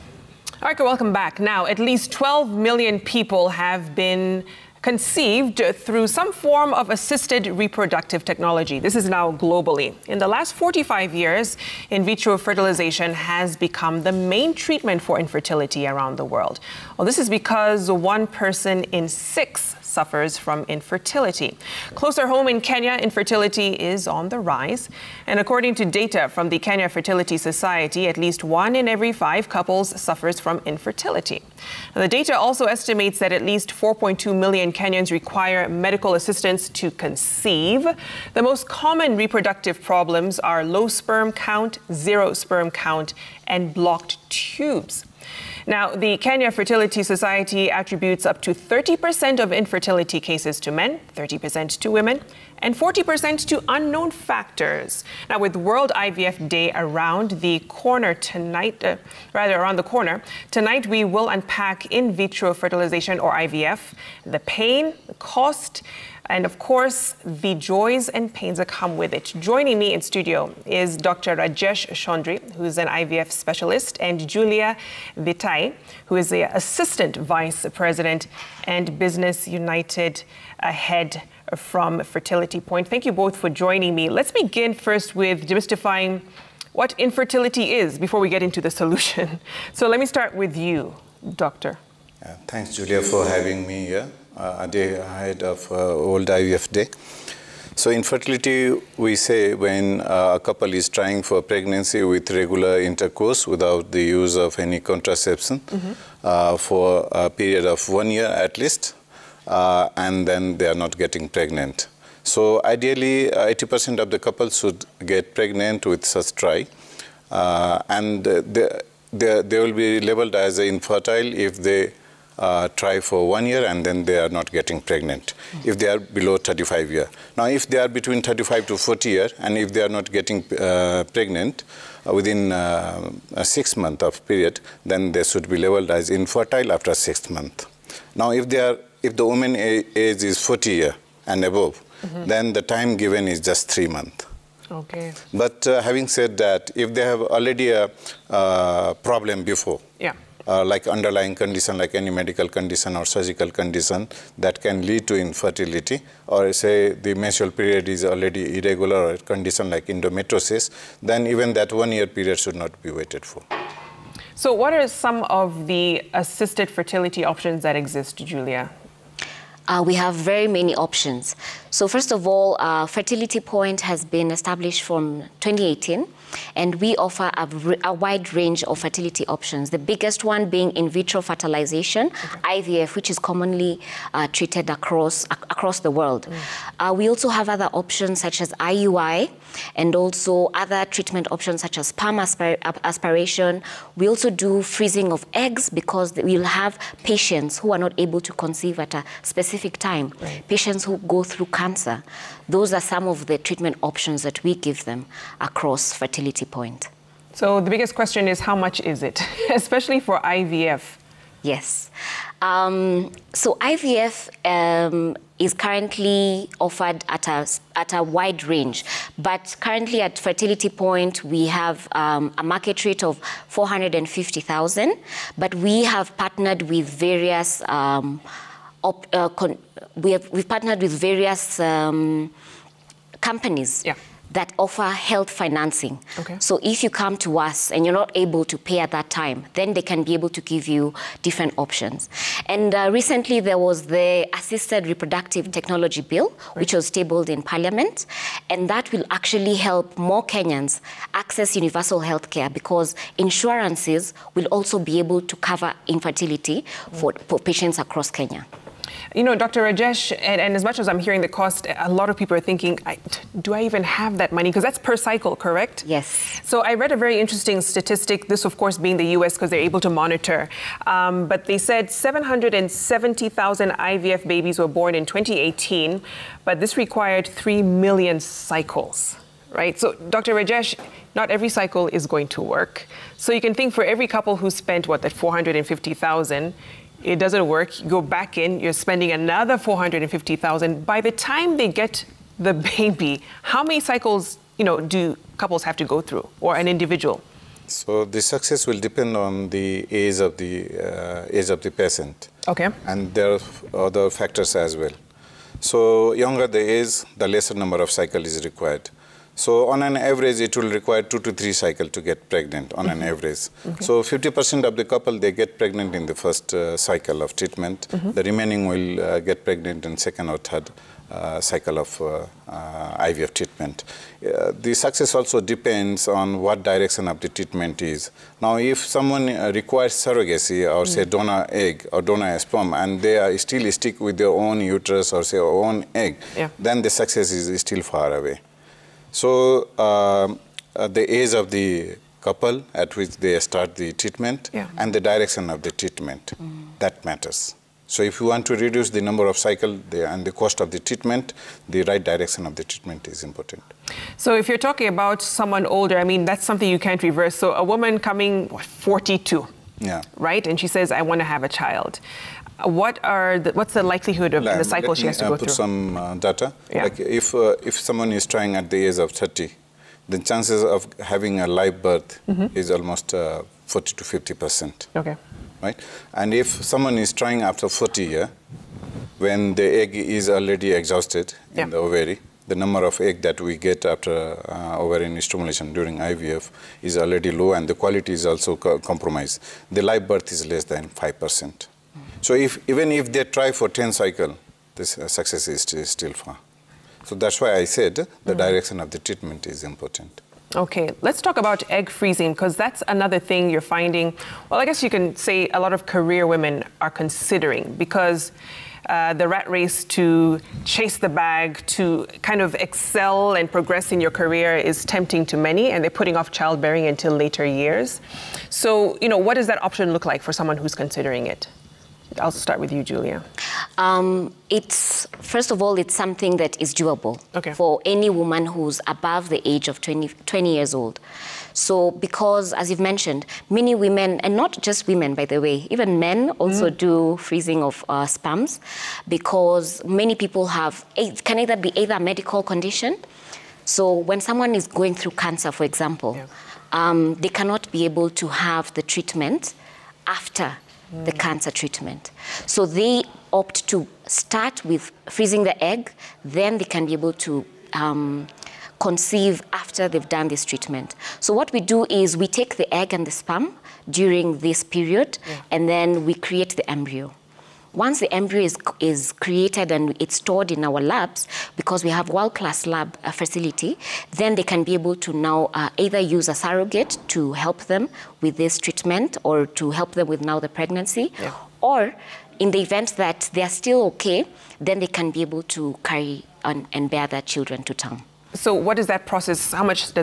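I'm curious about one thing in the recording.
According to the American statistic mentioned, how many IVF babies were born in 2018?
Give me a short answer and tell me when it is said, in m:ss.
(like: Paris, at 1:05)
770,000, at 4:31.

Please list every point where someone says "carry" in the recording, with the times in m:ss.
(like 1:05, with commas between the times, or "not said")
8:05.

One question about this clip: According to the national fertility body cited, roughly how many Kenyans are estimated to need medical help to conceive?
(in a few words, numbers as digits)
4.2 million.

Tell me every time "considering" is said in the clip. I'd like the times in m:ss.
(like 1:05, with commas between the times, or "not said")
6:46, 7:00.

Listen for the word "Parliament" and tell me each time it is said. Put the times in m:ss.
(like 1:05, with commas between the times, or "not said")
4:07.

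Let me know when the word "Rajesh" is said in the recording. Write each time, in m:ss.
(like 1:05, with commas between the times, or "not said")
1:11, 4:19, 4:40.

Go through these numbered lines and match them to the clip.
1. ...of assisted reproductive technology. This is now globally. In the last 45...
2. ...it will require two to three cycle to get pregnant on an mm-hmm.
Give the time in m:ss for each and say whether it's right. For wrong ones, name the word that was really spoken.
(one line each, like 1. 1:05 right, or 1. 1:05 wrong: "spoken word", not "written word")
1. 0:06 right
2. 5:10 right.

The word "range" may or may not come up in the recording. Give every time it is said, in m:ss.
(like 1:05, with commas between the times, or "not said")
2:58, 3:38.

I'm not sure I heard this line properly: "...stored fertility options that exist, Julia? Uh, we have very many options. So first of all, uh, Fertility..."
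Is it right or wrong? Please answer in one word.
wrong.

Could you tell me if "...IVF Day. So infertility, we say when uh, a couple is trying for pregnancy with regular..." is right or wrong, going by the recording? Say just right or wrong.
right.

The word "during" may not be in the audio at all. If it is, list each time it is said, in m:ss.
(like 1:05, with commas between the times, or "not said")
6:25, 7:43.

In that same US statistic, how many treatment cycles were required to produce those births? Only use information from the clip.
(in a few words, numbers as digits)
3 million.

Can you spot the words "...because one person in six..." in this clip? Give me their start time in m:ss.
0:17.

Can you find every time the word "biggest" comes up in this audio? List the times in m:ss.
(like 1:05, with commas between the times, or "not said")
2:59, 3:27.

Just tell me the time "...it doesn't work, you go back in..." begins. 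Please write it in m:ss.
4:47.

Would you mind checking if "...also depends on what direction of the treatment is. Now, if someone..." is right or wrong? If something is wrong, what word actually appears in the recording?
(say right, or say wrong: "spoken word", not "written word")
right.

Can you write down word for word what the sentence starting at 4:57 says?
So the success will depend on the age of the uh, age of the patient.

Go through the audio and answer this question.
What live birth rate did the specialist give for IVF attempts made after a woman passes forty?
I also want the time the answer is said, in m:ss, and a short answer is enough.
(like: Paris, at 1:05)
less than 5%, at 6:30.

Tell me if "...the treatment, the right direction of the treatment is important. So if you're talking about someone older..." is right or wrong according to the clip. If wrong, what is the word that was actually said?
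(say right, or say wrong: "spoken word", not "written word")
right.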